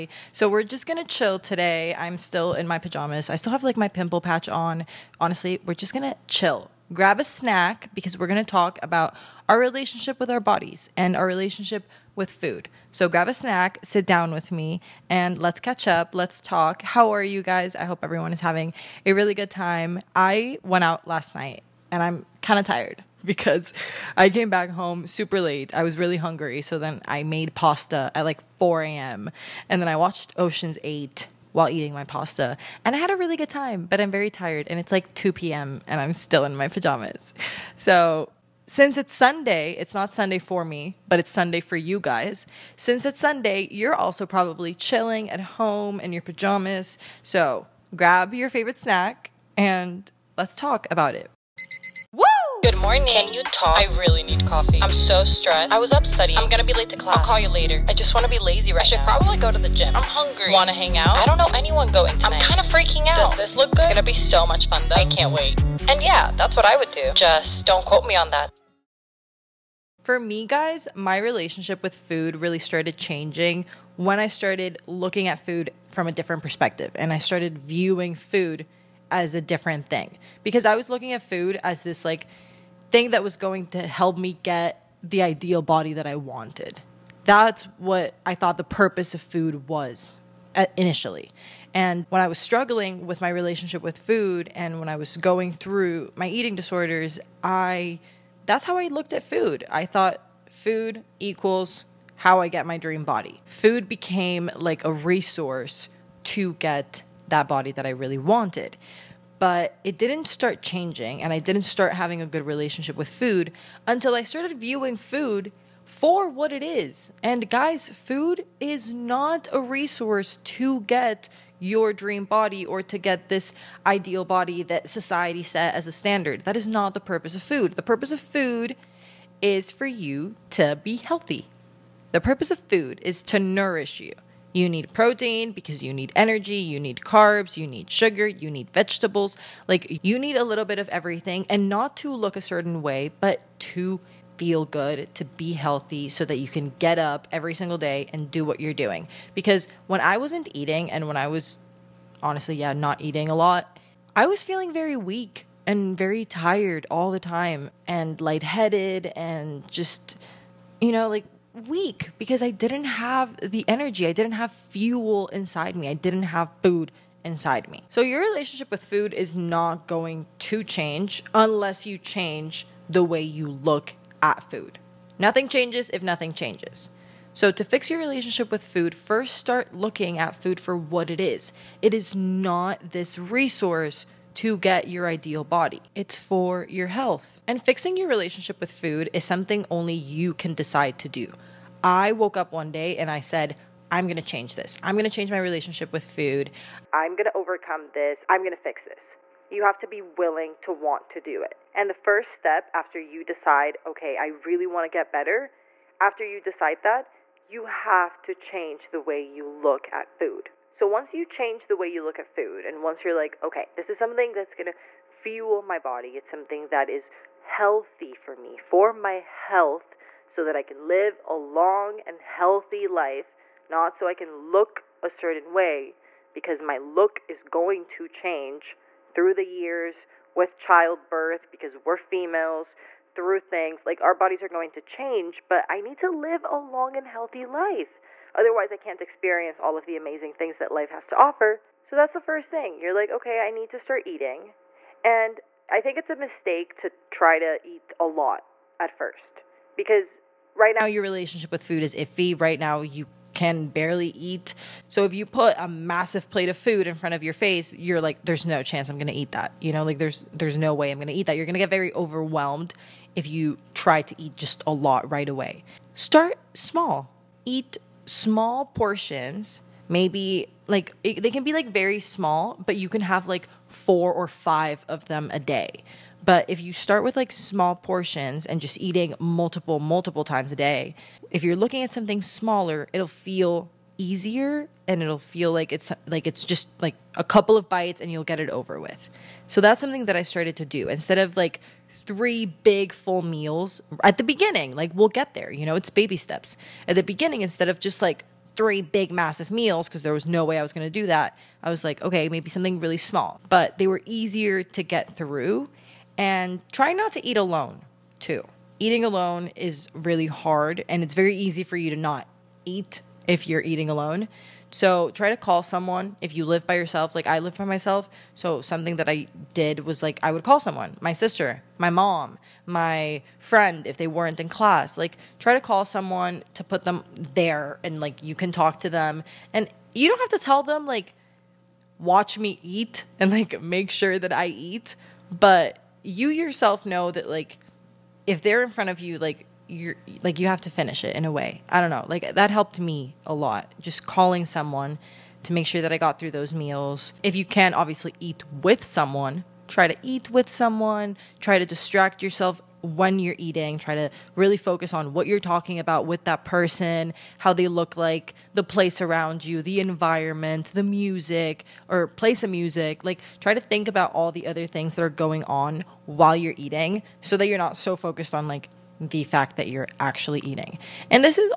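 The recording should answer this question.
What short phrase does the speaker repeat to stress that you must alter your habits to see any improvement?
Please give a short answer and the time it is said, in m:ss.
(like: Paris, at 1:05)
Nothing changes if nothing changes, at 2:55.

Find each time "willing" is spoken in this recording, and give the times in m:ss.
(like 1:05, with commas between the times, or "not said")
3:20.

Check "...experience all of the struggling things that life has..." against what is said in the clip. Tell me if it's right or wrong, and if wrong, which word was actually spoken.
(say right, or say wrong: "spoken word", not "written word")
wrong: "amazing", not "struggling".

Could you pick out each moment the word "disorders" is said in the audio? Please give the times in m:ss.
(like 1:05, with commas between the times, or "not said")
1:36.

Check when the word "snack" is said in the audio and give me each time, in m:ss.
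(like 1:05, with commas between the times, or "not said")
0:07, 0:13, 0:48.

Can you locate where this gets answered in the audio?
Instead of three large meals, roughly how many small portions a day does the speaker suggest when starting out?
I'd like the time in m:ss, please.
4:33.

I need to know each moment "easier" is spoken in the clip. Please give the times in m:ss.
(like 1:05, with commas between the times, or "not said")
4:43, 5:04.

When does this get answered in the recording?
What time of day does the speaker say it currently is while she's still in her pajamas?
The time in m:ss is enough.
0:35.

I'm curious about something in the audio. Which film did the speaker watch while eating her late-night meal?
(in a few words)
Ocean's 8.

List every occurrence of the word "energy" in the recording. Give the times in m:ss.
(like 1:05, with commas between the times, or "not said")
2:16, 2:43.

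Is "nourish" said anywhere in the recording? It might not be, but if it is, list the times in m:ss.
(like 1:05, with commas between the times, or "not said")
2:13.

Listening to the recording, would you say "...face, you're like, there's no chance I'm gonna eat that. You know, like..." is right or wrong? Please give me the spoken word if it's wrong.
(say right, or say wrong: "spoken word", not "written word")
right.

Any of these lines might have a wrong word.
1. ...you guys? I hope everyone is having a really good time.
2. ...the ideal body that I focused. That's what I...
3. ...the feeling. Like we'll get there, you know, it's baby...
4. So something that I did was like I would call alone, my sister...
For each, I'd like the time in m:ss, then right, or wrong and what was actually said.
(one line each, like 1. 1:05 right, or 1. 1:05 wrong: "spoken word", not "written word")
1. 0:17 right
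2. 1:25 wrong: "wanted", not "focused"
3. 4:54 wrong: "beginning", not "feeling"
4. 5:18 wrong: "someone", not "alone".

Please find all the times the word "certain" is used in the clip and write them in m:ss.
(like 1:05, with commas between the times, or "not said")
2:22, 3:45.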